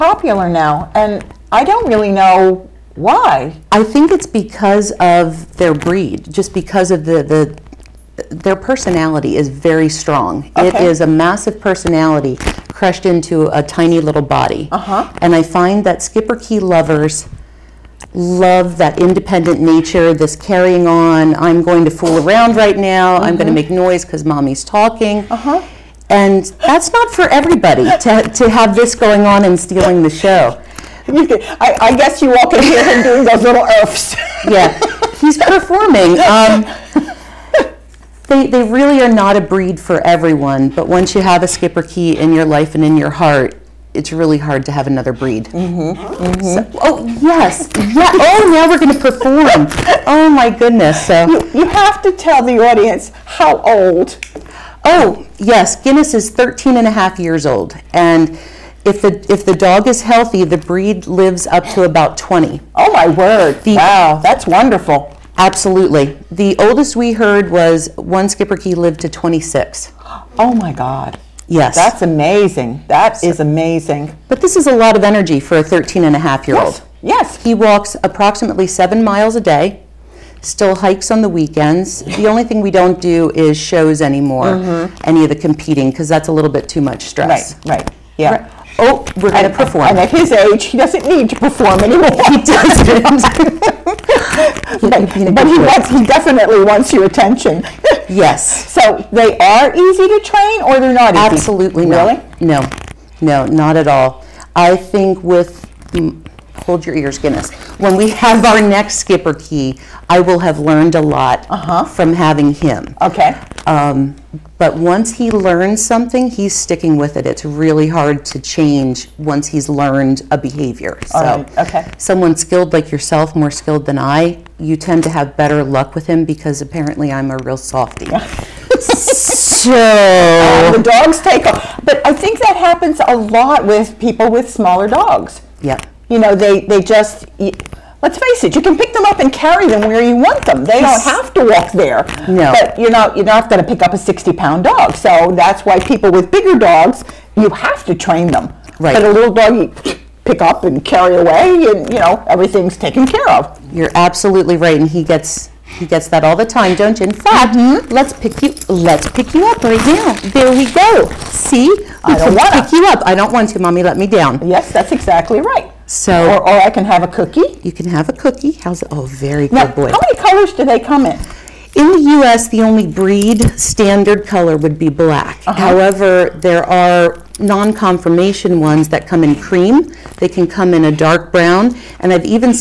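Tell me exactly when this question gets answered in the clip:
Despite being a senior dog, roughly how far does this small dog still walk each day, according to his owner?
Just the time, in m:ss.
1:18.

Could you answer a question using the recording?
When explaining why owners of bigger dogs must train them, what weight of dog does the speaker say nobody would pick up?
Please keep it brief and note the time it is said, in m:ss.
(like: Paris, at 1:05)
60 pounds, at 2:23.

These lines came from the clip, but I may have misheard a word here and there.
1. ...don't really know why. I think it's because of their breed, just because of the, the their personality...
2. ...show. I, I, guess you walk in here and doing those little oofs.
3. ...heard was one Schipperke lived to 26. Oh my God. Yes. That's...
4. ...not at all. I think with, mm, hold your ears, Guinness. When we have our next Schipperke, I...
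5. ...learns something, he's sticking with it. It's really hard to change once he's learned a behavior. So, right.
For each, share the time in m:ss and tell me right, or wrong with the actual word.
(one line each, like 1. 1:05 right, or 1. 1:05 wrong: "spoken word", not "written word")
1. 0:01 right
2. 0:30 right
3. 1:07 right
4. 1:43 right
5. 1:55 right.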